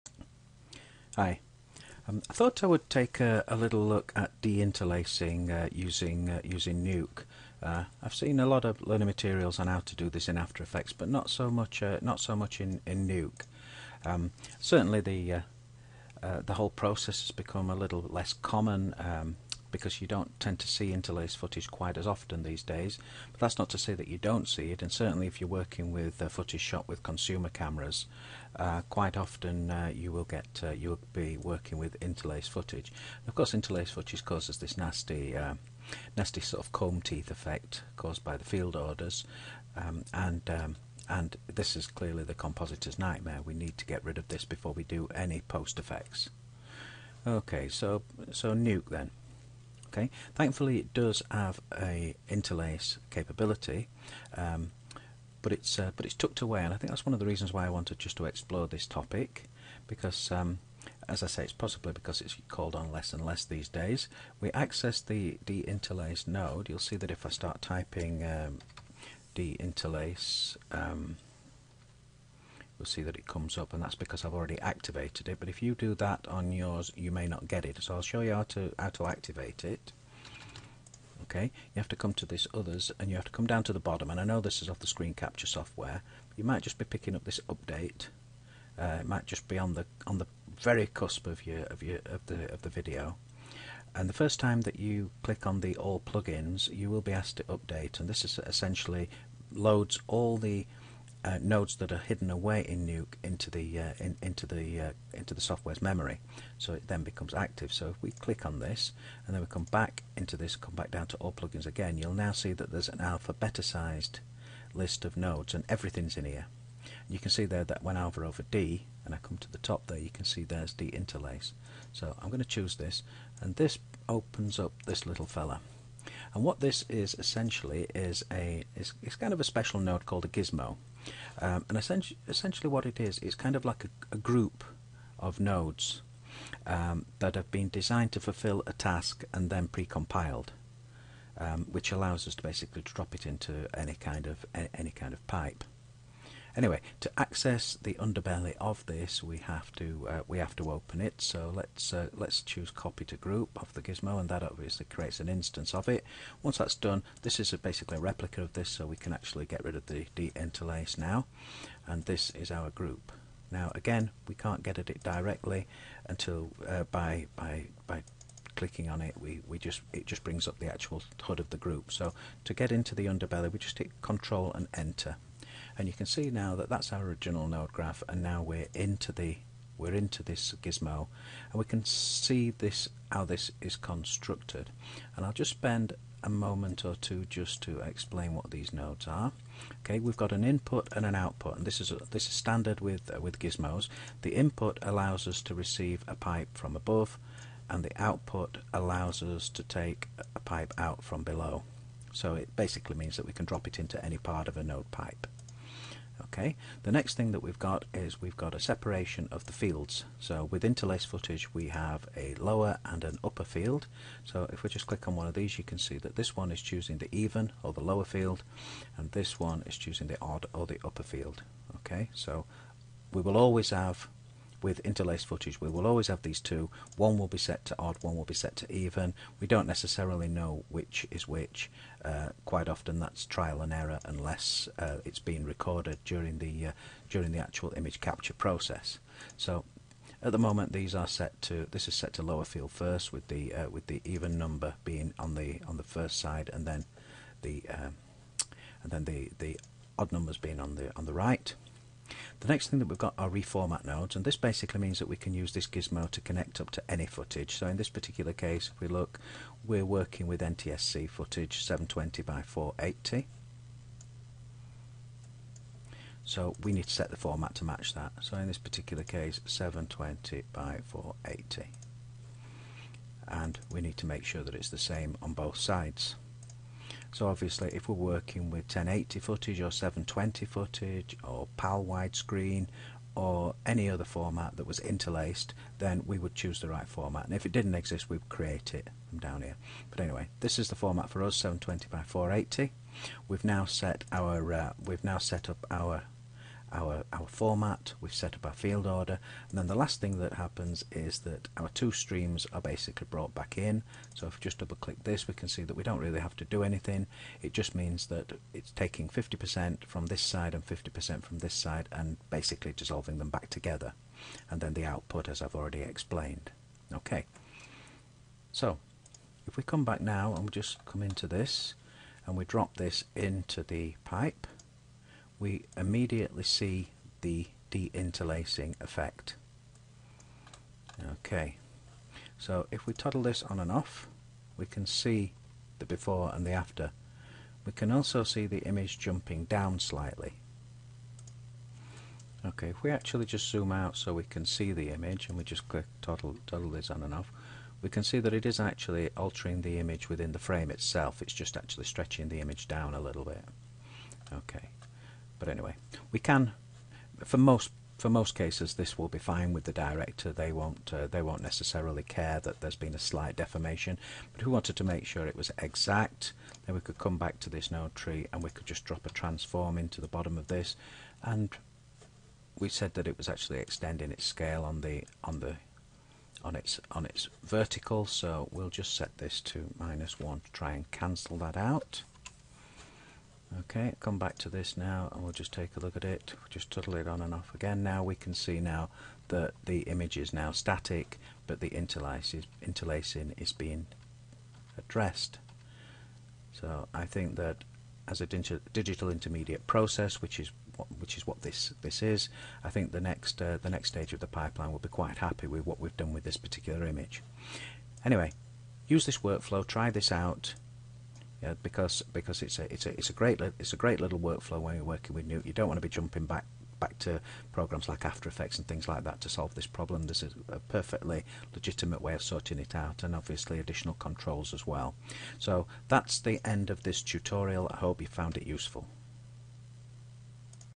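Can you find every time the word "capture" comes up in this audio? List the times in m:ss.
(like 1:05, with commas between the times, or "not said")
1:25, 3:58.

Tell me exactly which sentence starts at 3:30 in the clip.
So with interlace footage we have a lower and an upper field.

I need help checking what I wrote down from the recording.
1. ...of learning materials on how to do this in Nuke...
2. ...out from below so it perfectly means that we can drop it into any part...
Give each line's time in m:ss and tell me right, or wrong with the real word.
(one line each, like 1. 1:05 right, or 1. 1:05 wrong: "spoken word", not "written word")
1. 0:08 wrong: "After", not "Nuke"
2. 3:20 wrong: "basically", not "perfectly".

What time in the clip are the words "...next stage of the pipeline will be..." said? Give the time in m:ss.
6:43.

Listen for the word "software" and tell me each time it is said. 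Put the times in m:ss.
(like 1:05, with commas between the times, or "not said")
1:25, 1:45.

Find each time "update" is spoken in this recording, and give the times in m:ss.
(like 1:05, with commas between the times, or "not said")
1:27, 1:37.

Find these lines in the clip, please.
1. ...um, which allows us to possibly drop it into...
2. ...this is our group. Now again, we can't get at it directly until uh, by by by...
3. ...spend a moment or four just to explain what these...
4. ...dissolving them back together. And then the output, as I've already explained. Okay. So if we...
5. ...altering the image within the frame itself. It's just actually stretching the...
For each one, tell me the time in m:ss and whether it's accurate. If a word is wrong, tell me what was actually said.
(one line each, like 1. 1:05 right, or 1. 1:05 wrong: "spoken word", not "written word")
1. 2:21 wrong: "basically", not "possibly"
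2. 2:42 right
3. 3:05 wrong: "two", not "four"
4. 5:12 right
5. 5:49 right.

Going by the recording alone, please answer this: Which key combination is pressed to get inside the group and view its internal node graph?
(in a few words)
Control and Enter.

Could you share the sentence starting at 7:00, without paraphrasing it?
There's a, perfectly legitimate way of sorting it out and obviously additional controls as well.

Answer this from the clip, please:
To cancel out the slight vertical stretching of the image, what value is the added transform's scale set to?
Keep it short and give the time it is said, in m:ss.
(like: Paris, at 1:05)
-1, at 6:19.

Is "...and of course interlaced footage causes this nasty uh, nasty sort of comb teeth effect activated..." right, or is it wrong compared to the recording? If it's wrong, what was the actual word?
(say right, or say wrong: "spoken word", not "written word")
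wrong: "caused", not "activated".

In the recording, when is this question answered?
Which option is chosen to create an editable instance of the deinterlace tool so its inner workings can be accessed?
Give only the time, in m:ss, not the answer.
2:32.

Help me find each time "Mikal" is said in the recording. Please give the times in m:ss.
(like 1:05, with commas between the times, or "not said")
not said.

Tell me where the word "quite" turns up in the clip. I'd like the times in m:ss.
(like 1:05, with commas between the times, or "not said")
0:21, 0:28, 3:52, 6:44.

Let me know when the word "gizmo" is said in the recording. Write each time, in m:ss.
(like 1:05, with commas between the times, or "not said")
2:10, 2:33, 3:00, 3:13, 4:15.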